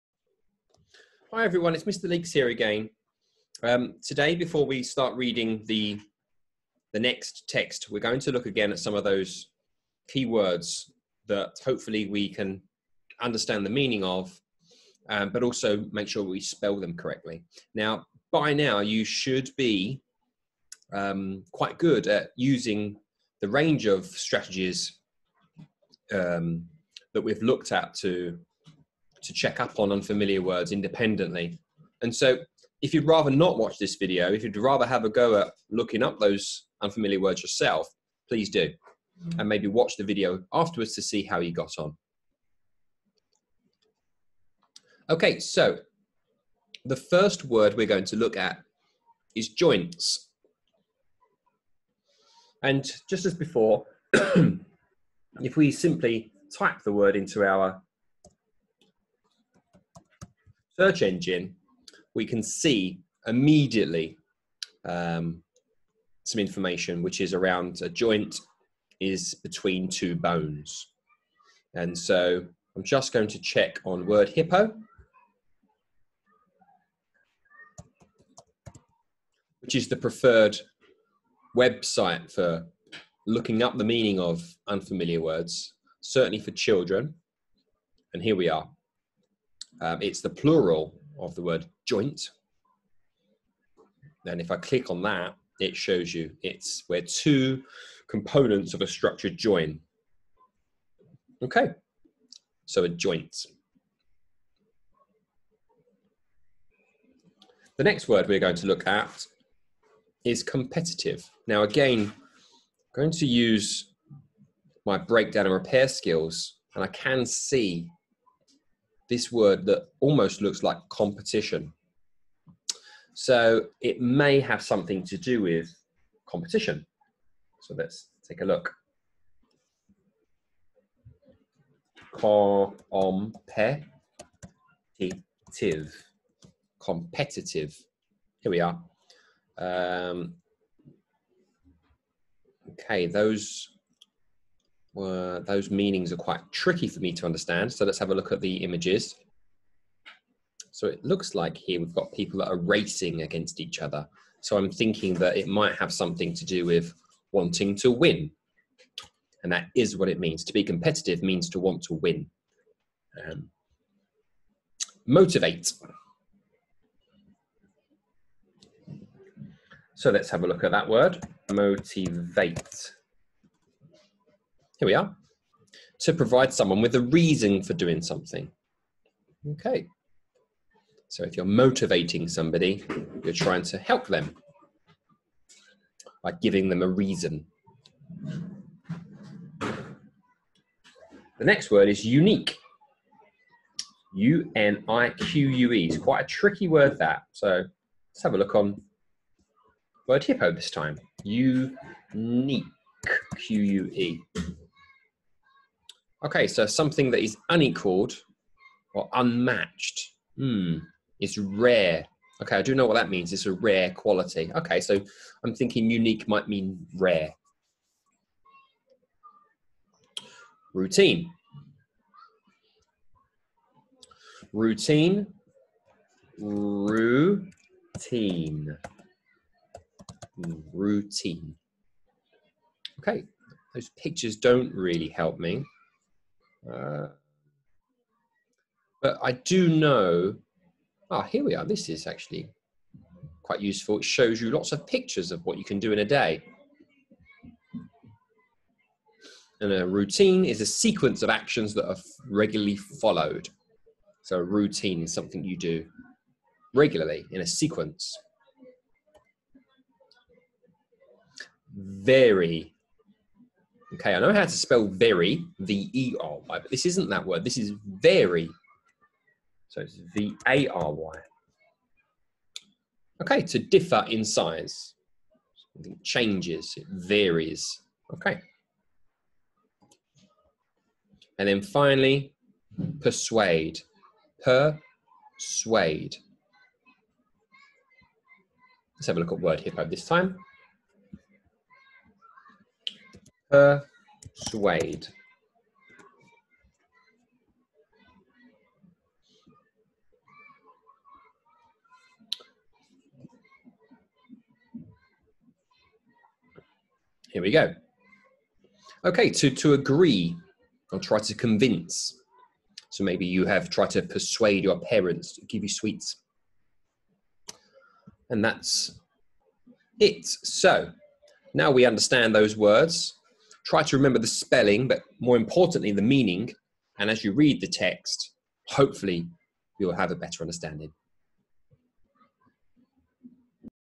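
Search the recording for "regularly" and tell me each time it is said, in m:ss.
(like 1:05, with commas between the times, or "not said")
4:12, 4:16.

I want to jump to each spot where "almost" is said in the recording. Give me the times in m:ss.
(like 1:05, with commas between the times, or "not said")
1:59.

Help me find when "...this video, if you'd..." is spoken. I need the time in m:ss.
0:33.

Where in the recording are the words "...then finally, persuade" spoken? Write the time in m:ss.
4:41.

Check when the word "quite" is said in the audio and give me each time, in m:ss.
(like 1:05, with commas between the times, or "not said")
0:21, 2:26, 3:15, 4:03.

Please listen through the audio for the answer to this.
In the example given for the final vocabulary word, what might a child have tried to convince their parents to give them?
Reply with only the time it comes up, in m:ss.
5:15.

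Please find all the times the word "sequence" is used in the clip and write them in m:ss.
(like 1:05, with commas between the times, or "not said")
4:10, 4:17.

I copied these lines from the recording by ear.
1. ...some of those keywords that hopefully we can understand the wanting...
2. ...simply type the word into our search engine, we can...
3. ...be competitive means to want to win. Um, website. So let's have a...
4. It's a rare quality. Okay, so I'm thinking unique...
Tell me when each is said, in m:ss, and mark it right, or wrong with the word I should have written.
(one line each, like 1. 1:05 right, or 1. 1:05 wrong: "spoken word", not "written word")
1. 0:08 wrong: "meaning", not "wanting"
2. 0:55 right
3. 2:40 wrong: "motivate", not "website"
4. 3:33 right.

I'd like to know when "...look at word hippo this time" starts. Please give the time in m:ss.
4:49.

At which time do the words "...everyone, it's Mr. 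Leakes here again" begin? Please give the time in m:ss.
0:01.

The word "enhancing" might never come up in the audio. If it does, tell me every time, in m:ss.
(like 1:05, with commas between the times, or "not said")
not said.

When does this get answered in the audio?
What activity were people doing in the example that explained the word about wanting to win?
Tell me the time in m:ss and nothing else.
2:32.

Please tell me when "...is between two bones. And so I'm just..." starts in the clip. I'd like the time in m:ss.
1:08.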